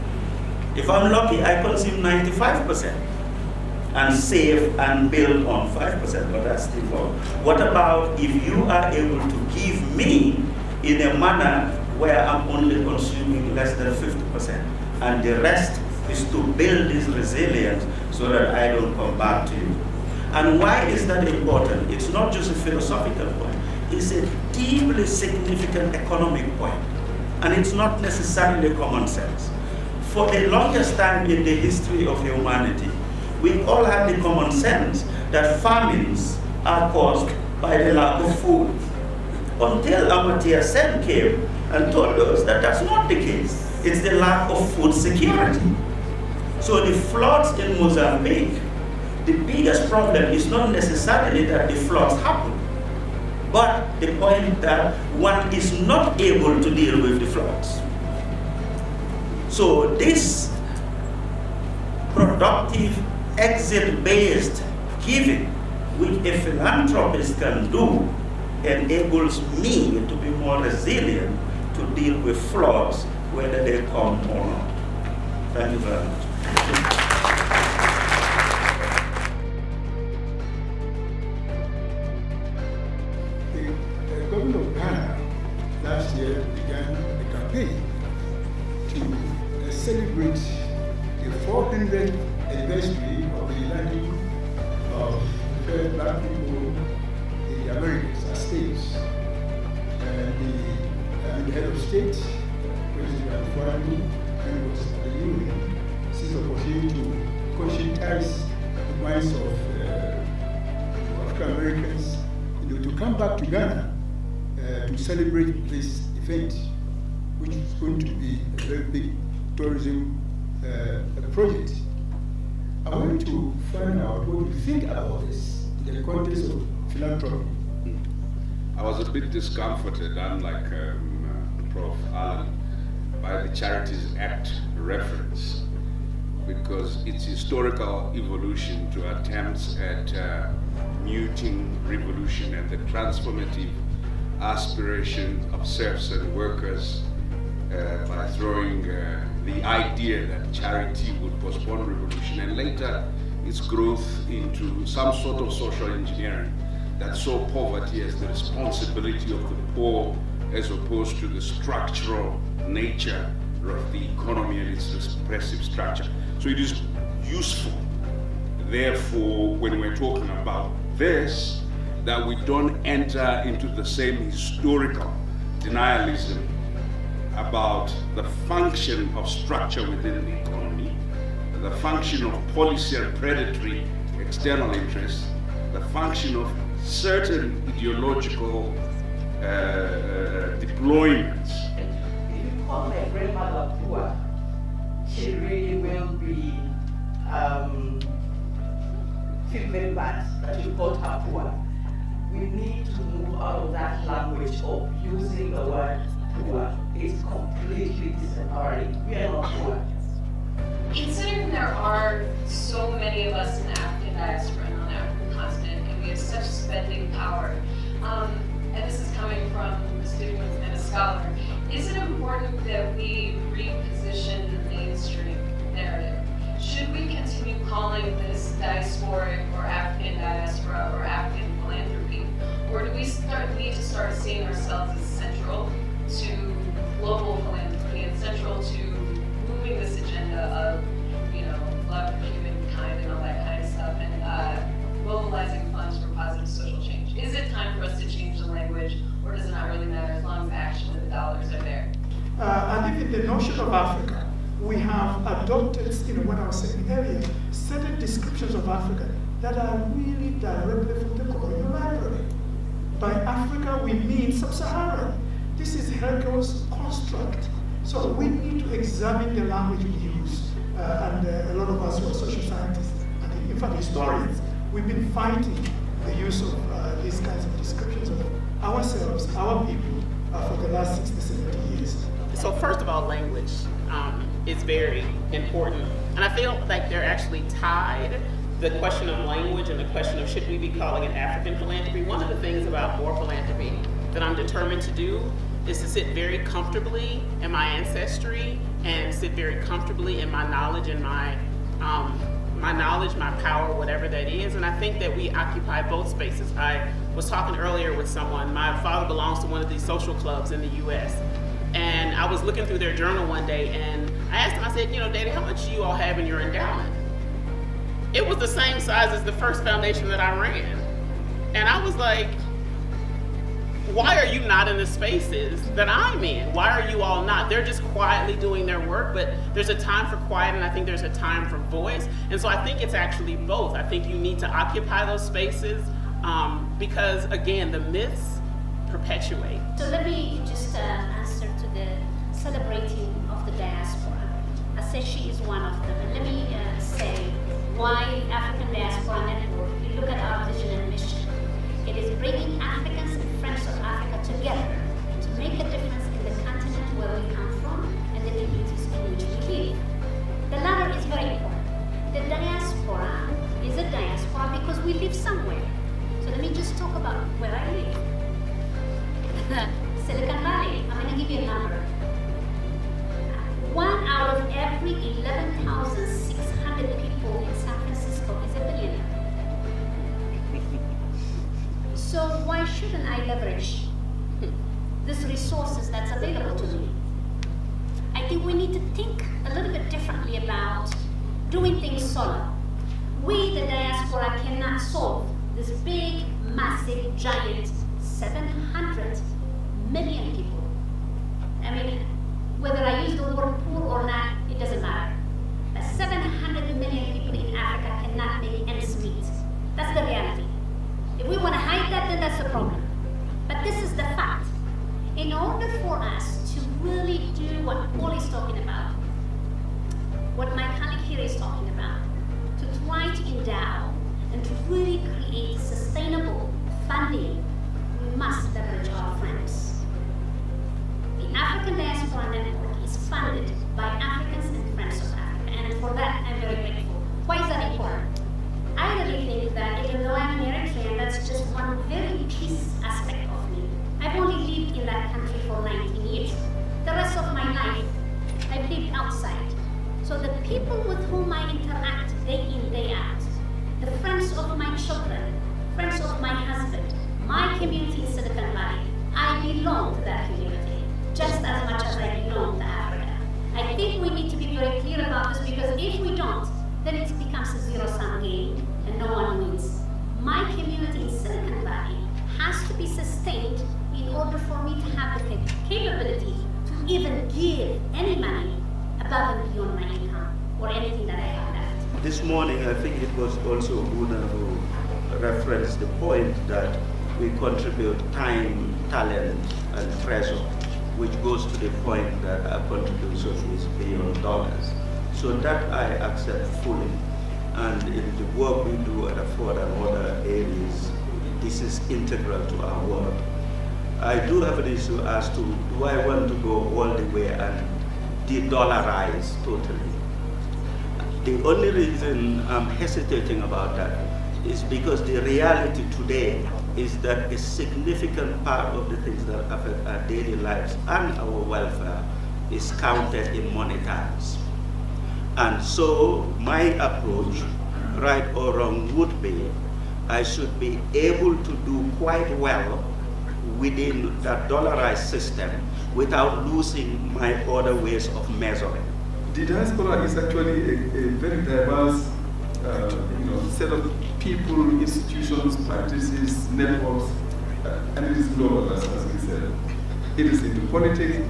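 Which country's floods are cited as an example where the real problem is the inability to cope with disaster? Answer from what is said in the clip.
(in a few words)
Mozambique.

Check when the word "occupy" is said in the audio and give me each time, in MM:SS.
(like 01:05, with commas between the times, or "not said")
05:05, 05:34.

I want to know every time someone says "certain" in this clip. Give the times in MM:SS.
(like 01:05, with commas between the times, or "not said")
03:06, 04:17.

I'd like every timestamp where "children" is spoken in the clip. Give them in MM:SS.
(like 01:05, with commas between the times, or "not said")
07:34.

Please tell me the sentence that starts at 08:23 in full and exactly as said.
I do have an issue as to do I want to go all the way and de-dollarize totally.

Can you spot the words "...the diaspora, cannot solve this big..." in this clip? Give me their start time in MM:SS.
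06:33.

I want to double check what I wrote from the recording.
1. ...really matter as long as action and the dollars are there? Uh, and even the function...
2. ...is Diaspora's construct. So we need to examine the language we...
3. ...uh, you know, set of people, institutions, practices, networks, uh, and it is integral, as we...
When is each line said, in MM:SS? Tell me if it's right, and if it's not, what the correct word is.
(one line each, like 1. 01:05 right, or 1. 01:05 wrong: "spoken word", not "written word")
1. 04:09 wrong: "notion", not "function"
2. 04:25 wrong: "Hegel", not "Diaspora"
3. 09:02 wrong: "global", not "integral".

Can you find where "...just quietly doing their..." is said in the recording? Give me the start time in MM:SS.
05:27.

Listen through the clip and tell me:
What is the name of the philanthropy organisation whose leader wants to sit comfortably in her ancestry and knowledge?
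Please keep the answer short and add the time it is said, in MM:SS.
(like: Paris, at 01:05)
Moore Philanthropy, at 04:53.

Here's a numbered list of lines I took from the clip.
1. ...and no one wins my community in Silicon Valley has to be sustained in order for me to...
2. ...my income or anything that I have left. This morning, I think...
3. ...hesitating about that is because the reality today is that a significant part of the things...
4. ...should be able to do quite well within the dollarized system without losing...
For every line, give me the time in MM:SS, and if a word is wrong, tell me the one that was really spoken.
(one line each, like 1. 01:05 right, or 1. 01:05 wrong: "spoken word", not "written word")
1. 07:48 right
2. 07:59 right
3. 08:32 right
4. 08:50 right.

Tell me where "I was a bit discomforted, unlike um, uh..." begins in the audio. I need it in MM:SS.
02:08.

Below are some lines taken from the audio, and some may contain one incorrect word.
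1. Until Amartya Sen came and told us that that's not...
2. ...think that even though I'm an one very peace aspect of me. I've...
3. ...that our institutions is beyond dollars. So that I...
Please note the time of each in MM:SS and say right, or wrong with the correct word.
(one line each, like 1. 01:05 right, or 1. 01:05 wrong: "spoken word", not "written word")
1. 00:39 right
2. 07:19 right
3. 08:12 wrong: "contributions", not "institutions".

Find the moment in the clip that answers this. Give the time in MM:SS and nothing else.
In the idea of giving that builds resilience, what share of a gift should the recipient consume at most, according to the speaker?
00:13.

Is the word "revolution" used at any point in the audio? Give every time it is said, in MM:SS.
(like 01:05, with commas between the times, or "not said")
02:21, 02:31.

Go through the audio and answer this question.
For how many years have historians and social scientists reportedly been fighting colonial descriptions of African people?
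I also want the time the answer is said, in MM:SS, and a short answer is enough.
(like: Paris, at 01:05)
60 to 70 years, at 04:41.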